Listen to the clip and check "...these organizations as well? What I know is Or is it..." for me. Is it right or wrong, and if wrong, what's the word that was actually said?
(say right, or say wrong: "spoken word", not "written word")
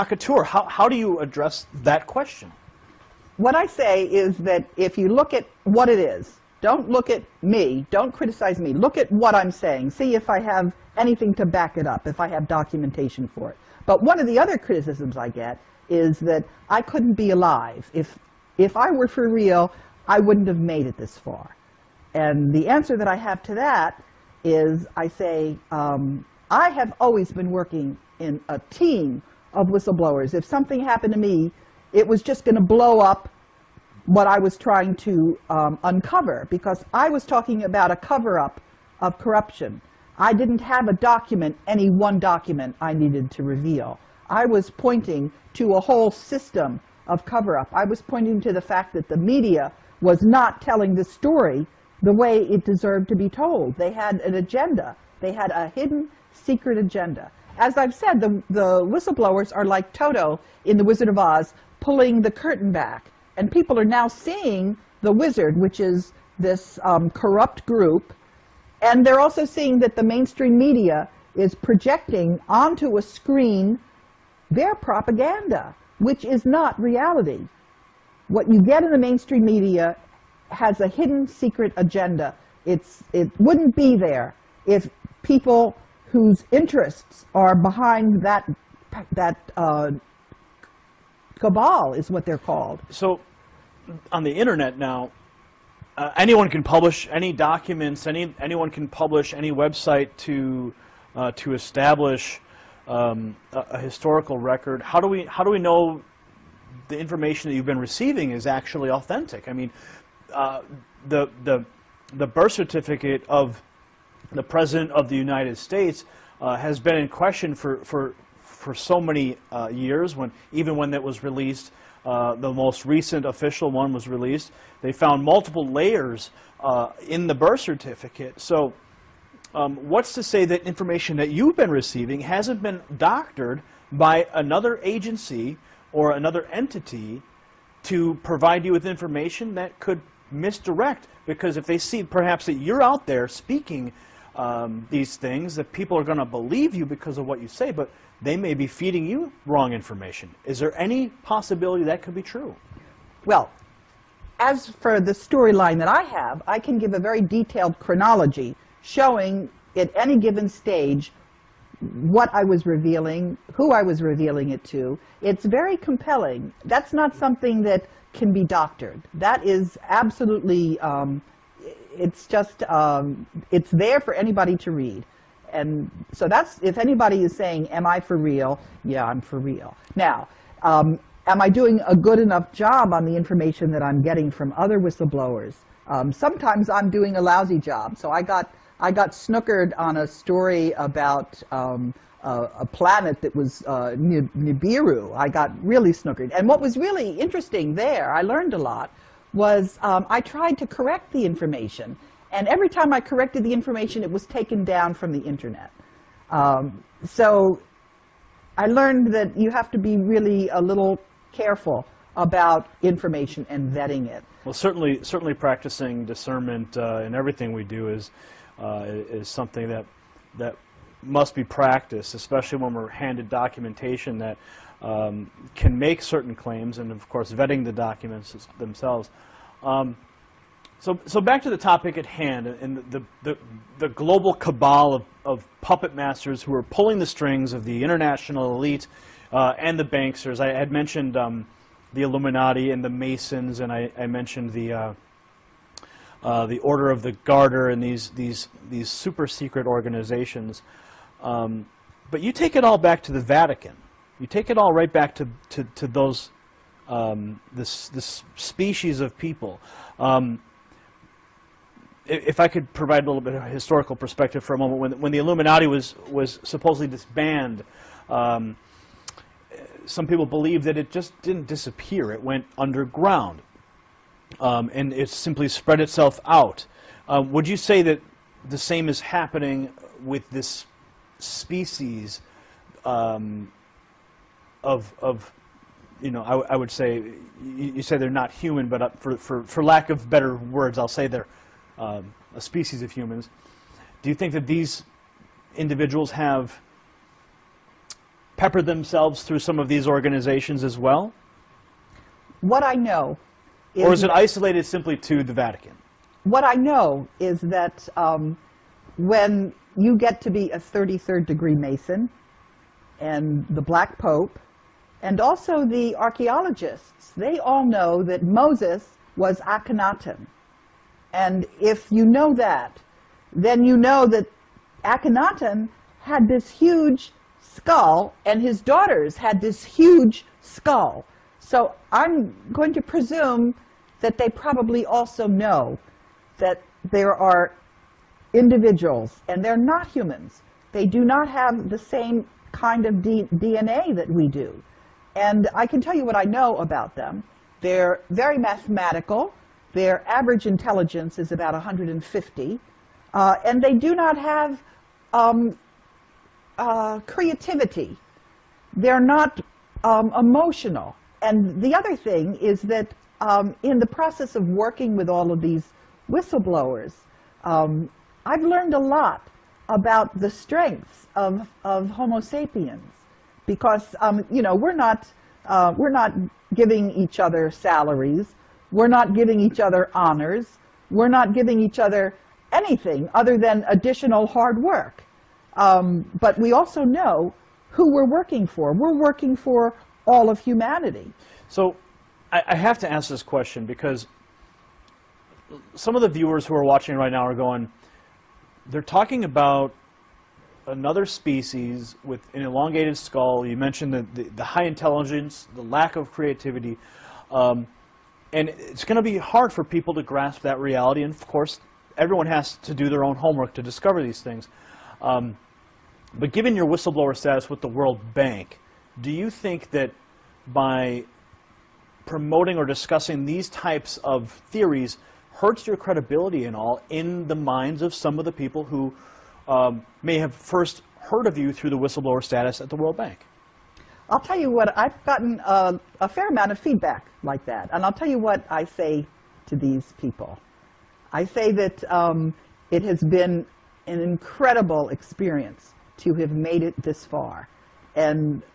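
right.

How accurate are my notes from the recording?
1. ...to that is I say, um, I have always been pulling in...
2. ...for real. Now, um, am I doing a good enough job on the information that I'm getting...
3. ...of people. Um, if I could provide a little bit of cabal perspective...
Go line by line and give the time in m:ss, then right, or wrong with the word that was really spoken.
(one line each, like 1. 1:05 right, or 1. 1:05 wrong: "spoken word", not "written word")
1. 0:23 wrong: "working", not "pulling"
2. 2:59 right
3. 4:18 wrong: "historical", not "cabal".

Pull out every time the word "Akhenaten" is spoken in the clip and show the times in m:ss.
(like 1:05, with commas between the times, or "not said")
5:19, 5:24.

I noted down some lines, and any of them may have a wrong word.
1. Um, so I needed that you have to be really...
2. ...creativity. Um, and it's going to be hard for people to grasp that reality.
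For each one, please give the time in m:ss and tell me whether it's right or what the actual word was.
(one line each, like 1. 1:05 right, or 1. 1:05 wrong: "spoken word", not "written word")
1. 3:26 wrong: "learned", not "needed"
2. 6:46 right.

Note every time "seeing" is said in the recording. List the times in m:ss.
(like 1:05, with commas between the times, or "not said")
1:04, 1:09.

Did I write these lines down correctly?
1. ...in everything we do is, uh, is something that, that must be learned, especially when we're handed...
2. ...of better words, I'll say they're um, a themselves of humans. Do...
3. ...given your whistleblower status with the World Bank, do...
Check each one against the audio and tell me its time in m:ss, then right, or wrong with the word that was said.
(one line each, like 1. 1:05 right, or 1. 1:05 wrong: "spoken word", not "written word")
1. 3:37 wrong: "practiced", not "learned"
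2. 4:49 wrong: "species", not "themselves"
3. 6:56 right.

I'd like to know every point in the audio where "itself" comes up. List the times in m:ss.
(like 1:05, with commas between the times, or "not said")
4:35.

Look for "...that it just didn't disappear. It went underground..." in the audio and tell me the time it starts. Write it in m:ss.
4:30.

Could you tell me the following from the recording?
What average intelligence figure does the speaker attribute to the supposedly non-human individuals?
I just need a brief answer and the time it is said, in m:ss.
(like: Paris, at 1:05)
150, at 5:51.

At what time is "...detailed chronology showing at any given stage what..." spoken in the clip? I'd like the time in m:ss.
2:37.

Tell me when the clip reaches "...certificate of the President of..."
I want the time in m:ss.
1:52.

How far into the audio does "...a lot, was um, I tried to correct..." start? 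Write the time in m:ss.
3:18.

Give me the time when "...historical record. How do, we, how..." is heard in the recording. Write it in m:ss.
1:43.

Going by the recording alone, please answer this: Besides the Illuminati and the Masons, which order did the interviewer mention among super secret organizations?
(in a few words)
Order of the Garter.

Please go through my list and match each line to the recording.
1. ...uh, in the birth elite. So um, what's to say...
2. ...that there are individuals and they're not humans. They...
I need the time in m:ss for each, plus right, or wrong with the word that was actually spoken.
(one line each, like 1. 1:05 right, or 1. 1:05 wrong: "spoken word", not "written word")
1. 2:06 wrong: "certificate", not "elite"
2. 5:36 right.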